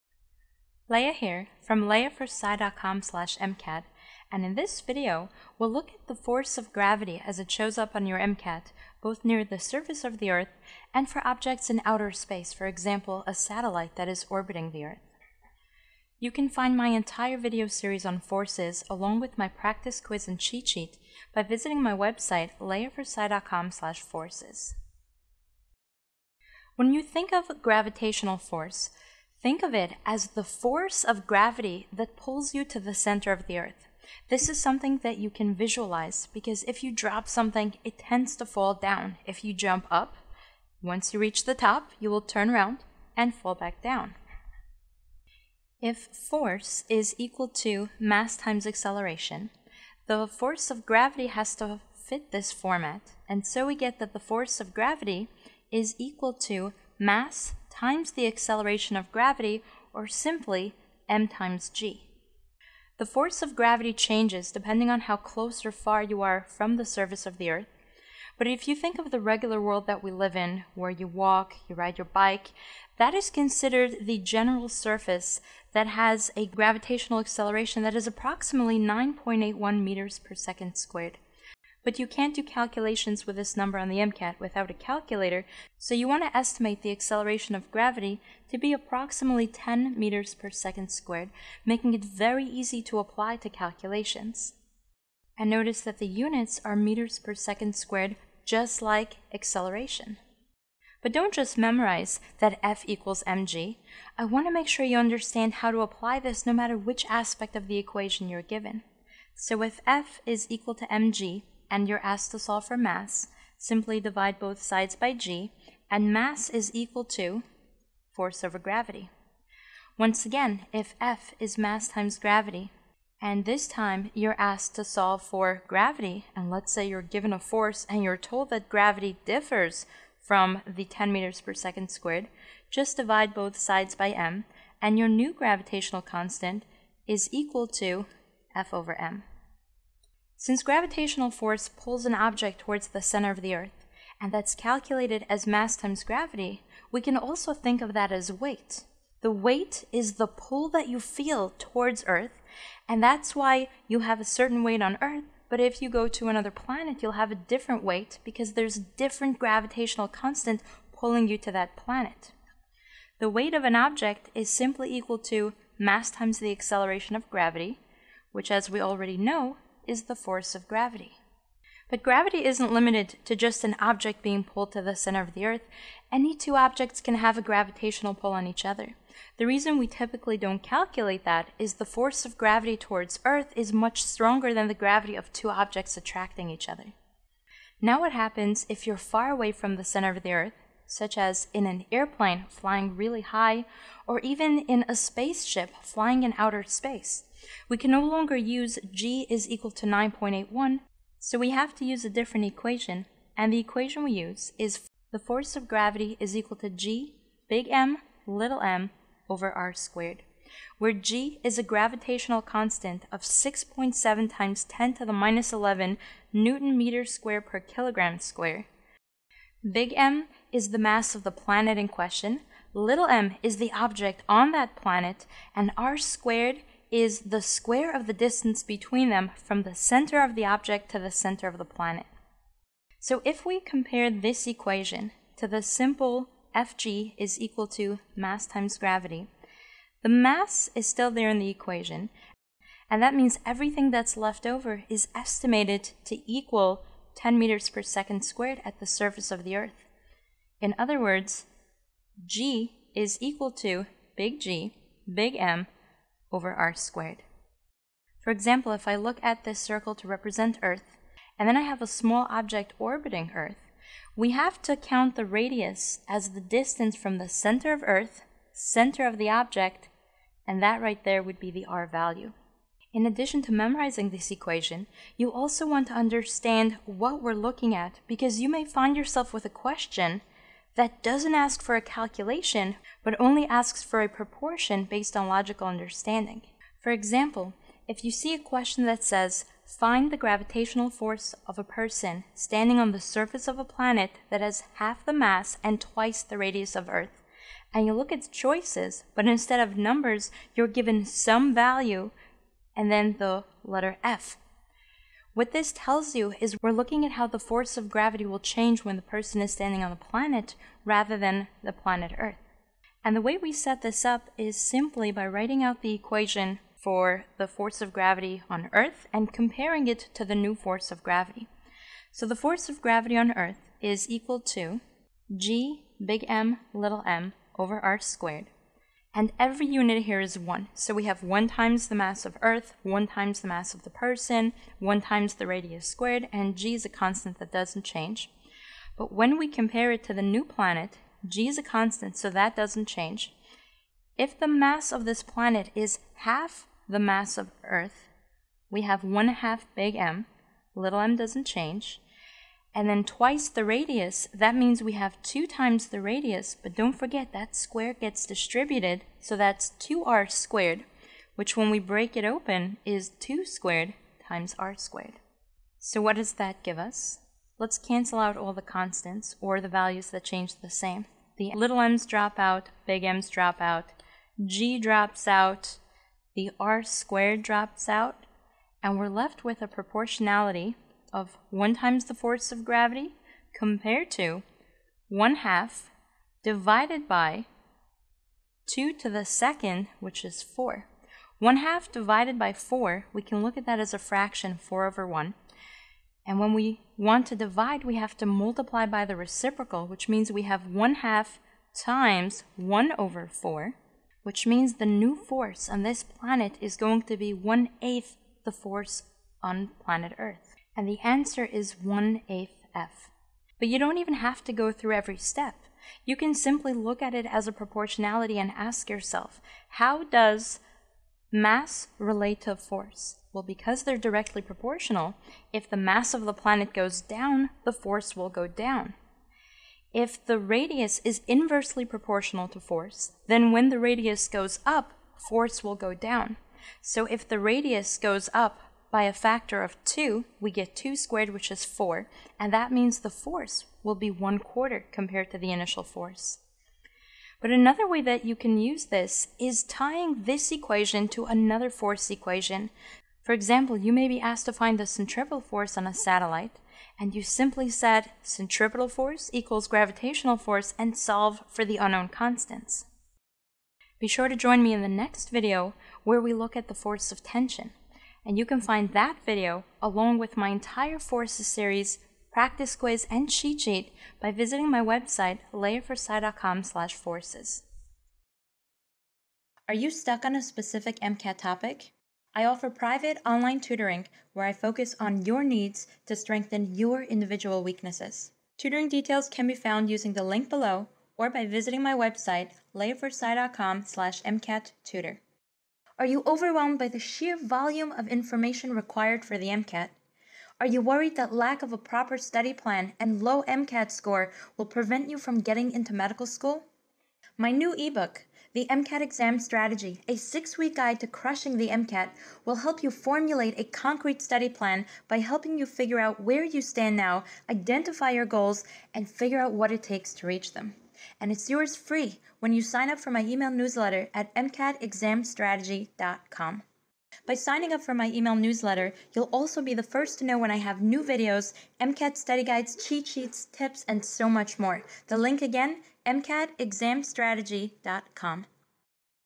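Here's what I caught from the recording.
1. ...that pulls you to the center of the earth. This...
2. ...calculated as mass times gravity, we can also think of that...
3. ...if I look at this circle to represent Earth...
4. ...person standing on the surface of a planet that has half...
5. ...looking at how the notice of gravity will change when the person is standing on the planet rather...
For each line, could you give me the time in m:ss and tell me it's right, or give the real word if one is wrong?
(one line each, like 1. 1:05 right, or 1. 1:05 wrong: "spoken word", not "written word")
1. 0:31 right
2. 2:24 right
3. 4:18 right
4. 4:51 right
5. 5:06 wrong: "force", not "notice".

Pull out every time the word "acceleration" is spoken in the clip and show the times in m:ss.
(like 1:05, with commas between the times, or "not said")
0:48, 0:58, 1:17, 1:26, 1:39, 2:46.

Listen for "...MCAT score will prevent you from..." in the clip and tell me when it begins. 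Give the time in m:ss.
8:23.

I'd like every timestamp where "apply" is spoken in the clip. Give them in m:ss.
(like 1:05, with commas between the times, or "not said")
1:32, 1:45.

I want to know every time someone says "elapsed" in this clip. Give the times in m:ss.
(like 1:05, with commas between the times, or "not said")
not said.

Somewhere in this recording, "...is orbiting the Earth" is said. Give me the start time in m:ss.
0:14.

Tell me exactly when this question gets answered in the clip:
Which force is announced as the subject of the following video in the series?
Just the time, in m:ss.
7:47.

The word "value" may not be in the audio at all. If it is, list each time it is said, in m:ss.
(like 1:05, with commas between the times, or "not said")
4:31, 5:01, 6:09.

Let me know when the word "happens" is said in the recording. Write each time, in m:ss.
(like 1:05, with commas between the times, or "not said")
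3:08.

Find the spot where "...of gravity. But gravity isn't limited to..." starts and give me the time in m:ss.
2:50.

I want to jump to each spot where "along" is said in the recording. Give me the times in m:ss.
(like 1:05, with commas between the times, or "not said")
0:18, 7:49.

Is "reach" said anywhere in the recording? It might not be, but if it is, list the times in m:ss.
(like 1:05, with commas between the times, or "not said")
0:41, 8:40.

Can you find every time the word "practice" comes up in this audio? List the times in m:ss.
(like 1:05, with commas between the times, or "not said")
0:19, 7:52.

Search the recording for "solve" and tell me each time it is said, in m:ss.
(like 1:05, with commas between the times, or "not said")
1:52, 2:04, 7:40.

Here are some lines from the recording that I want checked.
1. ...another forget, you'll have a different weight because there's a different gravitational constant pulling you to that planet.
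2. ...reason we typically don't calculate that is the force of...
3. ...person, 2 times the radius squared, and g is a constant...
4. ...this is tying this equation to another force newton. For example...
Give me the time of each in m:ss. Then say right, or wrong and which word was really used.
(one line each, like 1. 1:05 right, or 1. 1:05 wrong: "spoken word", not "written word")
1. 2:36 wrong: "planet", not "forget"
2. 2:59 right
3. 5:33 wrong: "1", not "2"
4. 7:28 wrong: "equation", not "newton".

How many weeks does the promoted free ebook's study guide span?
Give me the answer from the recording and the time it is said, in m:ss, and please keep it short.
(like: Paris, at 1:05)
6, at 8:30.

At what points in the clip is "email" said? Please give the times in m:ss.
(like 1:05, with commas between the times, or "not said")
8:43, 8:48.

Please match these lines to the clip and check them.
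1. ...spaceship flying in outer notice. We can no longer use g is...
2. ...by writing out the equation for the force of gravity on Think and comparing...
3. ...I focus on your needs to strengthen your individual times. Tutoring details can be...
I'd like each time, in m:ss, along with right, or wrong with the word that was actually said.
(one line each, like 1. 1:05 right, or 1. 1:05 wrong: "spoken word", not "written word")
1. 3:14 wrong: "space", not "notice"
2. 5:15 wrong: "Earth", not "Think"
3. 8:04 wrong: "weaknesses", not "times".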